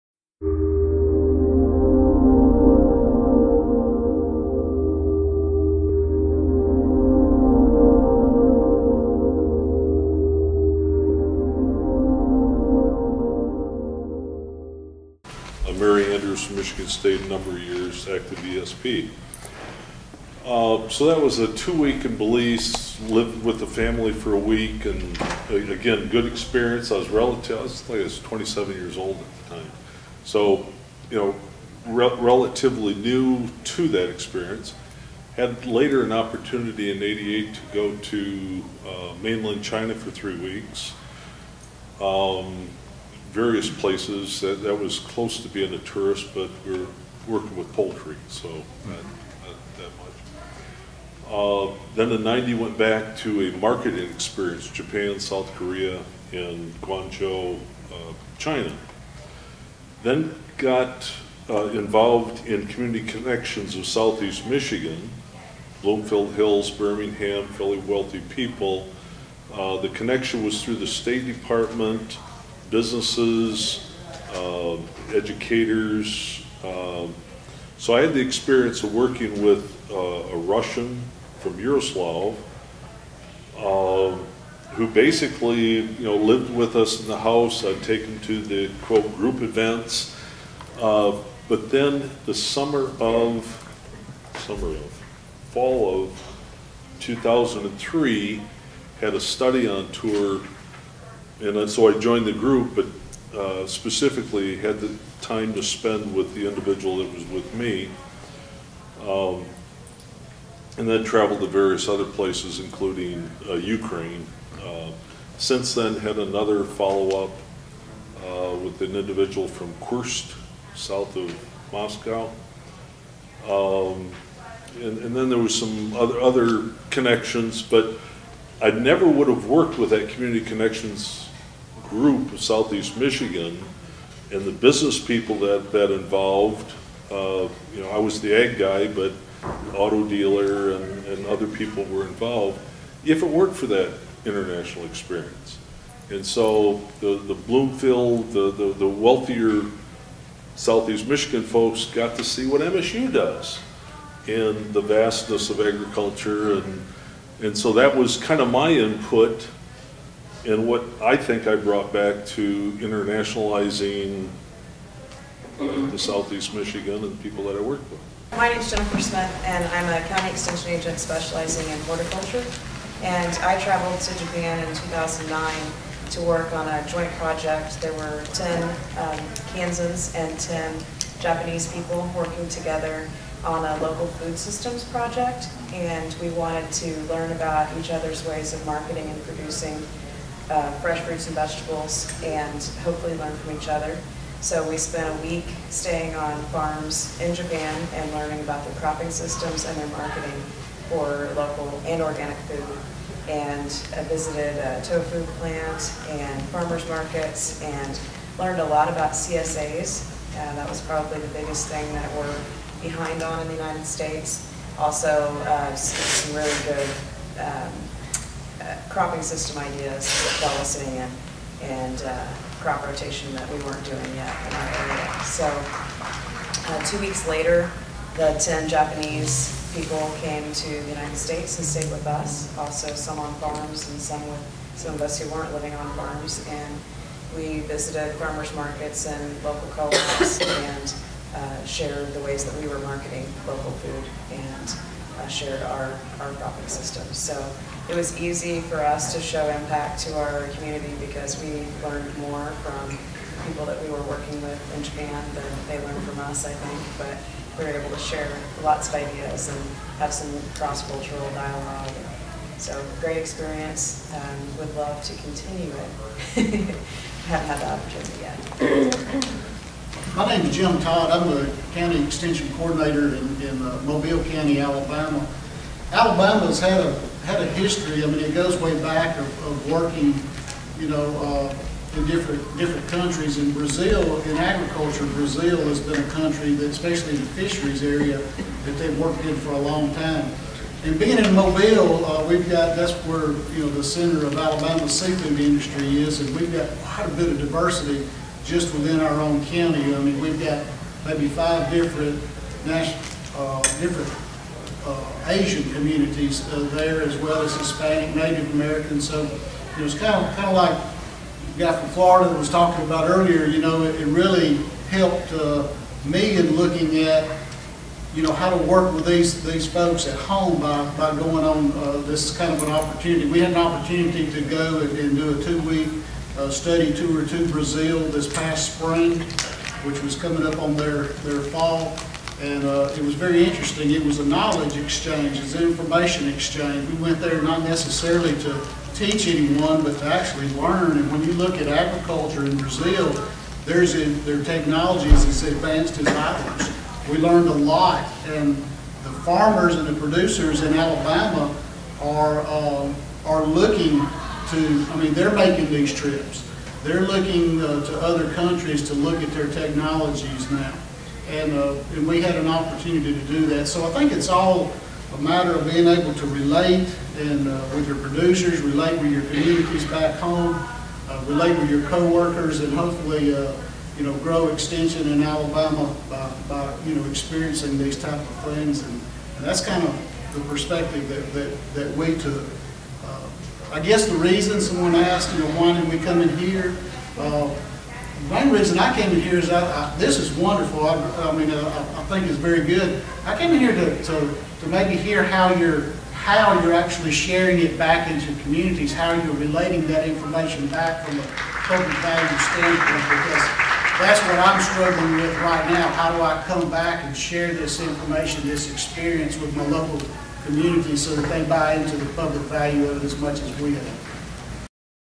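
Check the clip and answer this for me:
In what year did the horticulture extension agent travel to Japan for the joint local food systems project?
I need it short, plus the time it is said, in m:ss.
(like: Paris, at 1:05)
2009, at 2:54.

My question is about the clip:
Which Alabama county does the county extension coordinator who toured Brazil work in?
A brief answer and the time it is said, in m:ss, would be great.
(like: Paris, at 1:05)
Mobile County, at 4:33.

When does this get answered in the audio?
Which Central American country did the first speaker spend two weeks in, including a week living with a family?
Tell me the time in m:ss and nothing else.
0:22.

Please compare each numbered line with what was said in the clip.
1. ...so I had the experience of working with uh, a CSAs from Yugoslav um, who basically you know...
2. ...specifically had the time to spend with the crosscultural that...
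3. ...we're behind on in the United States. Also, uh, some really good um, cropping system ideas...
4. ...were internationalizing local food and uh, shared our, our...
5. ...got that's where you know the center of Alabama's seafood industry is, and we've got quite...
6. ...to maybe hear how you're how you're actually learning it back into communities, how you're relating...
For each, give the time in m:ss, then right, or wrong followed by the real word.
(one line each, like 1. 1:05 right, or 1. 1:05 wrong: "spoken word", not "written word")
1. 1:17 wrong: "Russian", not "CSAs"
2. 1:43 wrong: "individual", not "crosscultural"
3. 3:32 right
4. 4:02 wrong: "marketing", not "internationalizing"
5. 4:52 right
6. 6:34 wrong: "sharing", not "learning".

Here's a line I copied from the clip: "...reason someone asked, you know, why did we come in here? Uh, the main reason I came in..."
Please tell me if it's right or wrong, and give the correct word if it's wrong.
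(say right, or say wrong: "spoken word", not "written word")
right.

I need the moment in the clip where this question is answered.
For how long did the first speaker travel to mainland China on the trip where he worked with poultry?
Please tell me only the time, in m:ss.
0:40.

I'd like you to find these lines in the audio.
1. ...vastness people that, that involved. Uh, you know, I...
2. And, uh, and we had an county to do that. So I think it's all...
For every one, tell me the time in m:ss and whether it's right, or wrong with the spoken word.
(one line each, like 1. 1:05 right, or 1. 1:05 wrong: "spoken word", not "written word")
1. 2:14 wrong: "business", not "vastness"
2. 6:01 wrong: "opportunity", not "county".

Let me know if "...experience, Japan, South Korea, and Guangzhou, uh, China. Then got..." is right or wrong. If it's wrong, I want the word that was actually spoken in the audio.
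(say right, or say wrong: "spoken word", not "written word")
right.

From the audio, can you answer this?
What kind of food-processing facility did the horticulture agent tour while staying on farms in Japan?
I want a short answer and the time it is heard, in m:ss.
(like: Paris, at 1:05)
tofu plant, at 3:24.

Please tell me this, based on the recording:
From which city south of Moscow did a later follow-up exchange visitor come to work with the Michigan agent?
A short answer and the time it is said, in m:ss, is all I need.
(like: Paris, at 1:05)
Kursk, at 1:59.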